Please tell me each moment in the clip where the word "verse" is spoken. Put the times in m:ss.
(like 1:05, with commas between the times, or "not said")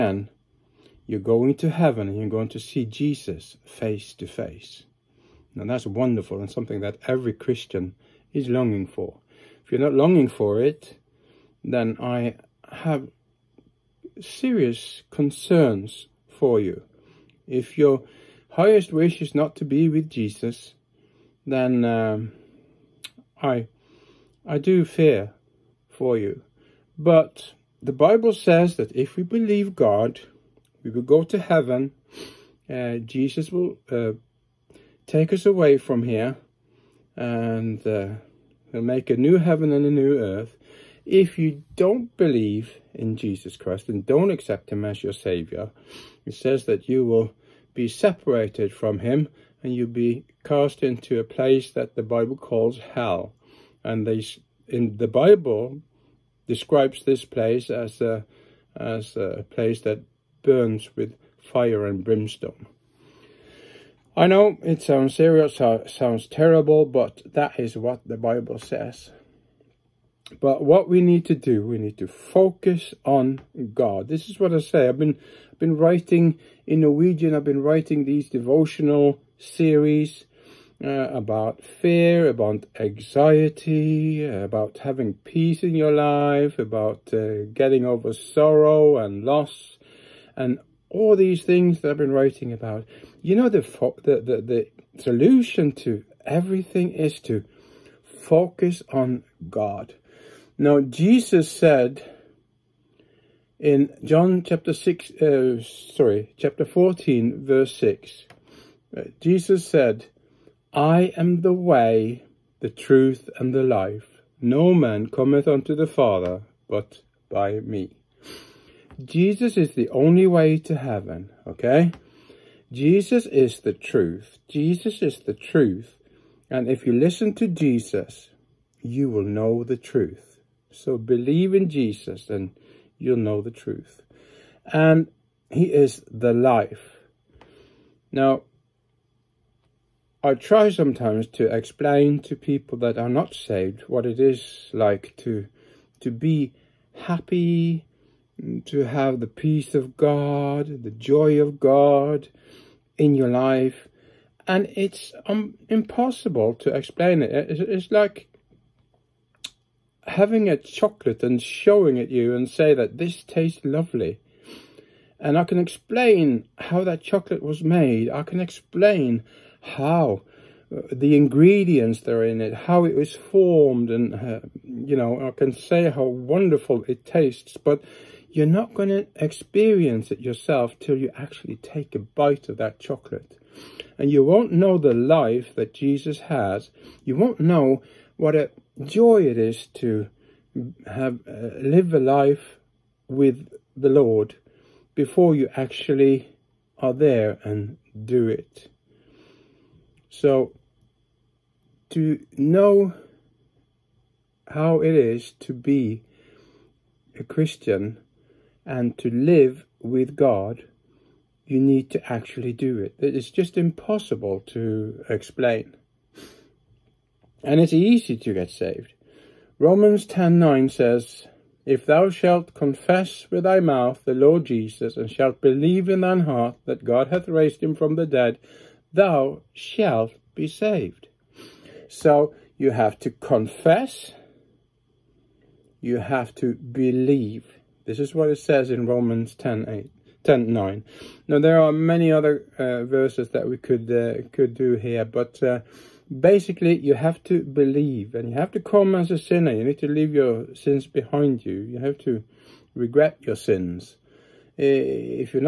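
1:47, 4:02.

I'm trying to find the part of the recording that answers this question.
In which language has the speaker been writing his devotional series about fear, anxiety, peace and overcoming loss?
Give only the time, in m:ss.
1:16.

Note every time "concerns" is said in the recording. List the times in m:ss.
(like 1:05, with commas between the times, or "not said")
0:15.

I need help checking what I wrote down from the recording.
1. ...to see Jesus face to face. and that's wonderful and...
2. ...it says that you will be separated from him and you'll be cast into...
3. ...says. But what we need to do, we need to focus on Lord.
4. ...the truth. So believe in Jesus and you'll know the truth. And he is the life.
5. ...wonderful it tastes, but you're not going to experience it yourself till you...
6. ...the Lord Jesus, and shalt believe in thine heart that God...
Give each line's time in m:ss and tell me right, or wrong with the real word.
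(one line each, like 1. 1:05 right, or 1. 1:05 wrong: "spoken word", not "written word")
1. 0:02 right
2. 0:46 right
3. 1:08 wrong: "God", not "Lord"
4. 2:09 right
5. 2:56 right
6. 3:44 right.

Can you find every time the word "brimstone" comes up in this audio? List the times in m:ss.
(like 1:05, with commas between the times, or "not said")
1:02.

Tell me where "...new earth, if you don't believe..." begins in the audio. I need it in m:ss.
0:39.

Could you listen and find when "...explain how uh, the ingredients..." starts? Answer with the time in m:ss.
2:48.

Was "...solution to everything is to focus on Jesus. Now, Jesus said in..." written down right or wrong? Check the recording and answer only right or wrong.
wrong.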